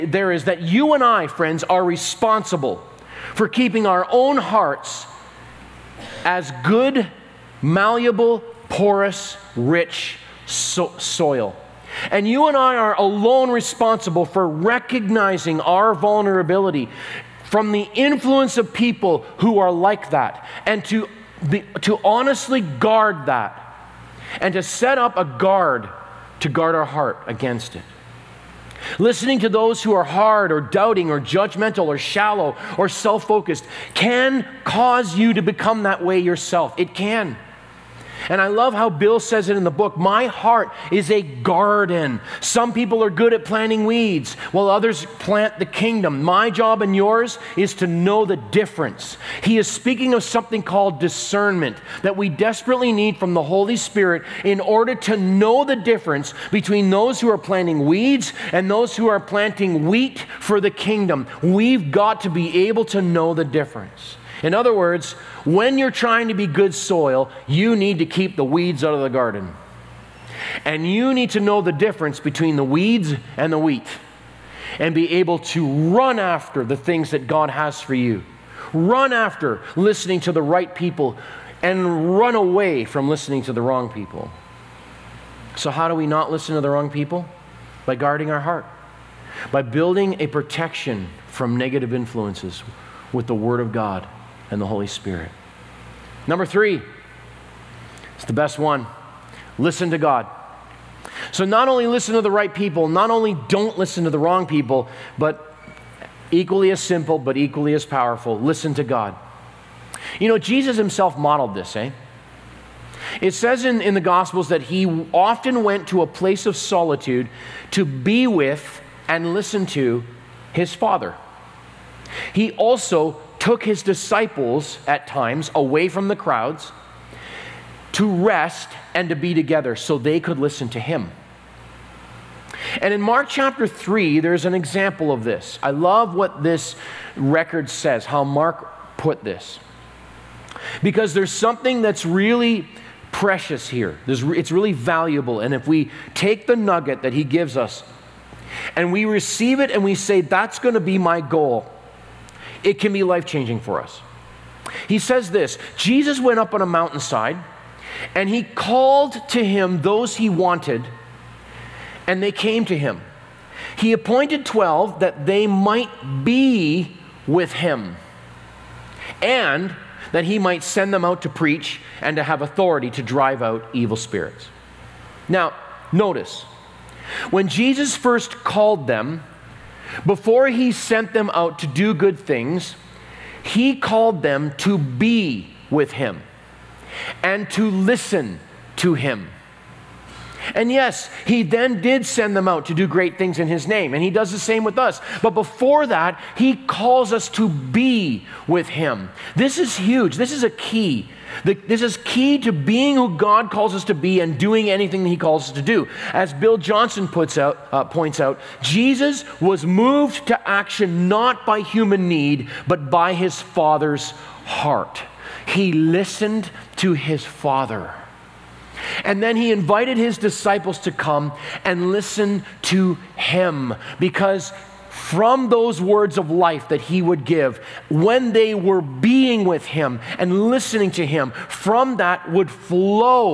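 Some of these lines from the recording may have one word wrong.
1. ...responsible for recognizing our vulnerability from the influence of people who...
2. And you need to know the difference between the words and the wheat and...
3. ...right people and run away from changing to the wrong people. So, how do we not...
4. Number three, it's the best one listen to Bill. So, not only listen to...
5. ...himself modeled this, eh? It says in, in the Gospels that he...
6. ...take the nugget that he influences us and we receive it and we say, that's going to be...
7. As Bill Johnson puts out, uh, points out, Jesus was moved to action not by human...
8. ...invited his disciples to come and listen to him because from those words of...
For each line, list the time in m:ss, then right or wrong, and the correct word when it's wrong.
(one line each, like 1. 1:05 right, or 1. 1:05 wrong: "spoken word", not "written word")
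1. 0:13 right
2. 1:10 wrong: "weeds", not "words"
3. 1:20 wrong: "listening", not "changing"
4. 1:36 wrong: "God", not "Bill"
5. 1:50 right
6. 2:26 wrong: "gives", not "influences"
7. 3:26 right
8. 3:39 right.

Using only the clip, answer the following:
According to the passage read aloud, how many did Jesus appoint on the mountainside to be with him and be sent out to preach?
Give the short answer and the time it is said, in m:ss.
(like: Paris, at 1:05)
12, at 2:44.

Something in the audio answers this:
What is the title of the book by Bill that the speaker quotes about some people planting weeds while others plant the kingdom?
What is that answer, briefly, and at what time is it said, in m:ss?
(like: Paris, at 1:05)
My Heart Is a Garden, at 0:39.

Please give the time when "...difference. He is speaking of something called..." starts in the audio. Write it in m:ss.
0:48.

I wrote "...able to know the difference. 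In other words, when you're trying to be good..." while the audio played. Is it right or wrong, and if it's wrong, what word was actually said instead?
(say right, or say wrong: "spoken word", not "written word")
right.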